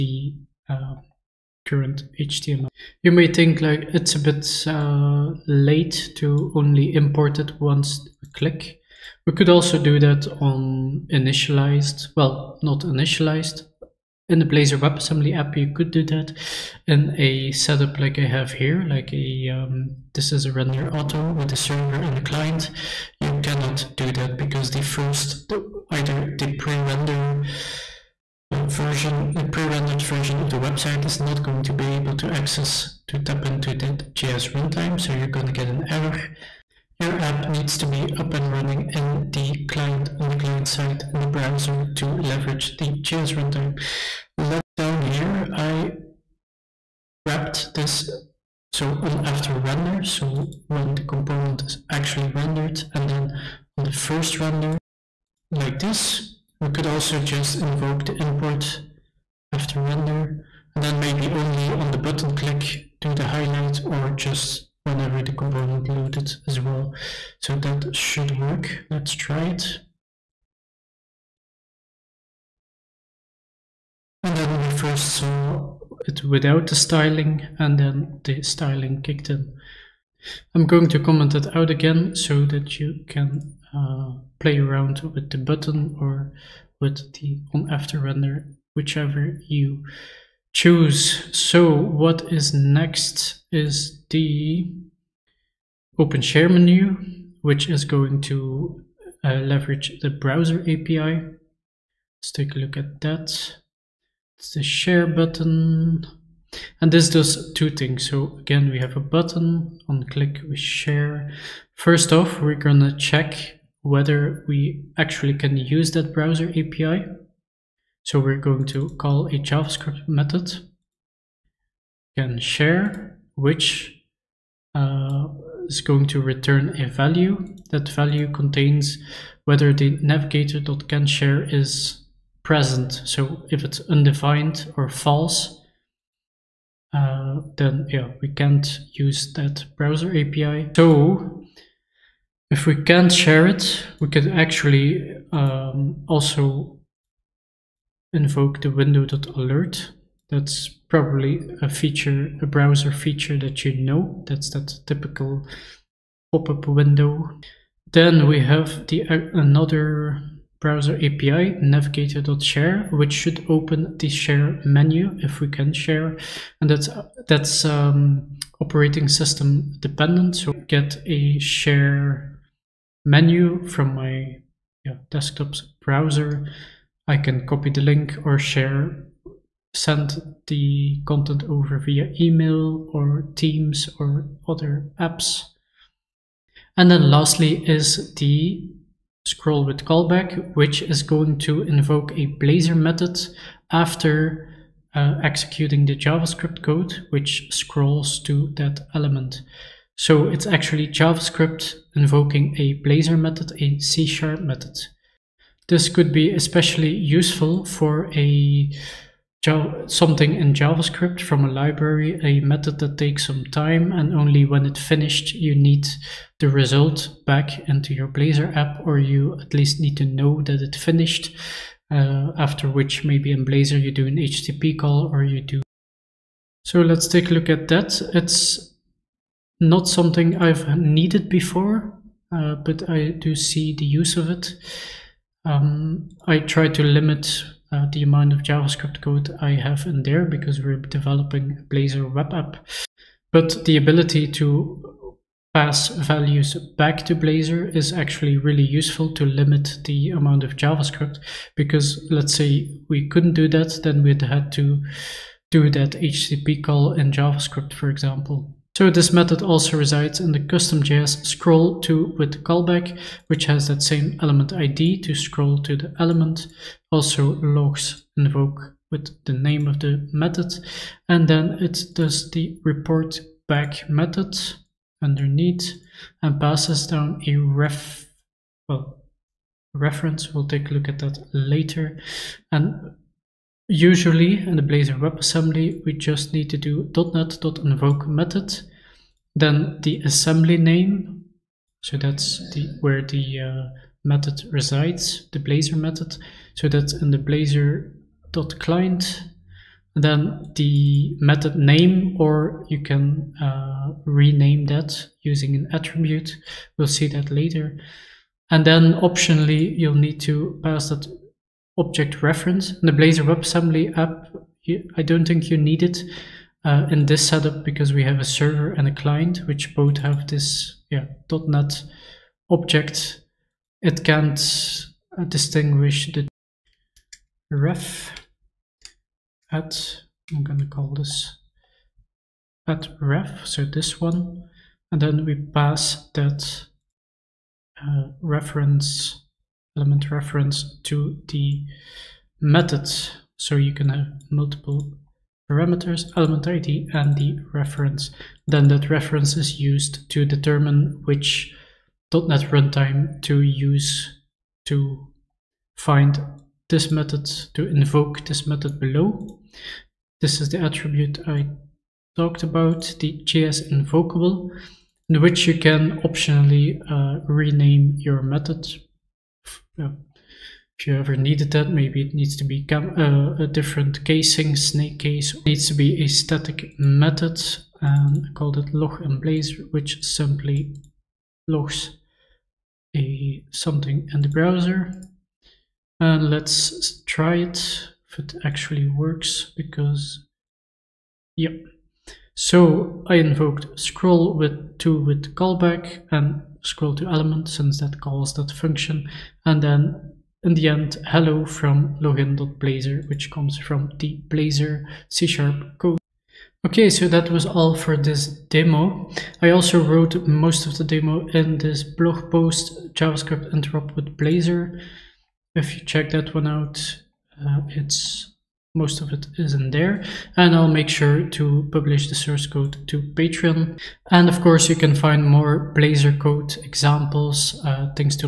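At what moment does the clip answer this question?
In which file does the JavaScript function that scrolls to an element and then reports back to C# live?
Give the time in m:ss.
4:20.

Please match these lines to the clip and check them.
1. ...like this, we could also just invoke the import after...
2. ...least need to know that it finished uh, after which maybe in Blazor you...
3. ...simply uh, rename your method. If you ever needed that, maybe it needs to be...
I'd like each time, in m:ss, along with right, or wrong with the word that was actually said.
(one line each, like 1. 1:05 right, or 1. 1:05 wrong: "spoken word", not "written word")
1. 0:55 right
2. 3:39 right
3. 6:06 wrong: "optionally", not "simply".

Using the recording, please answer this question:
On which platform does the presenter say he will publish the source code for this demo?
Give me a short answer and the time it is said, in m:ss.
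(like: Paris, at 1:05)
Patreon, at 7:03.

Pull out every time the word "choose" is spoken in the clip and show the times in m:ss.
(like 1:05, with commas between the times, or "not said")
1:30.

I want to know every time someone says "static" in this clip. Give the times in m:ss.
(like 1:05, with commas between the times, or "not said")
6:16.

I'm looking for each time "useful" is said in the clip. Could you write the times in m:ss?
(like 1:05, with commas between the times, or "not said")
3:26, 4:08.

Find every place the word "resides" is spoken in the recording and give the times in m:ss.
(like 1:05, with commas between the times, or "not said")
4:19, 4:54.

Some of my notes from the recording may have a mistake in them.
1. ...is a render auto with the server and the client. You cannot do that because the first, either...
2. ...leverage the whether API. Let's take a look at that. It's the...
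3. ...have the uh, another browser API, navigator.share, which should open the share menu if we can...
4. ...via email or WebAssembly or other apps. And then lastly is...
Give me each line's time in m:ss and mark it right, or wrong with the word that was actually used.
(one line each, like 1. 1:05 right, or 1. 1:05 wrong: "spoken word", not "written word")
1. 0:20 right
2. 1:39 wrong: "browser", not "whether"
3. 2:38 right
4. 3:01 wrong: "Teams", not "WebAssembly".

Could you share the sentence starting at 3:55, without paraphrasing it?
Um, I try to limit uh, the amount of JavaScript code I have in there because we're developing Blazor web app.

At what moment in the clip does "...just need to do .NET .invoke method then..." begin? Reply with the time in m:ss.
4:45.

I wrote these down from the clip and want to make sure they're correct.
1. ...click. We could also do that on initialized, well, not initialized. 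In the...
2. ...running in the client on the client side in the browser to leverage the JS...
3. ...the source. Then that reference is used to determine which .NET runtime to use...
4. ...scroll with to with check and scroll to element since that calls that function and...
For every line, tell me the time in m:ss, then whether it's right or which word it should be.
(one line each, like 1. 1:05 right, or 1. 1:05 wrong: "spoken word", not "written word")
1. 0:08 right
2. 0:38 right
3. 5:47 wrong: "reference", not "source"
4. 6:33 wrong: "callback", not "check".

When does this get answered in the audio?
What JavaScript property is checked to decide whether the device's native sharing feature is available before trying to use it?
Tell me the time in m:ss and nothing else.
2:10.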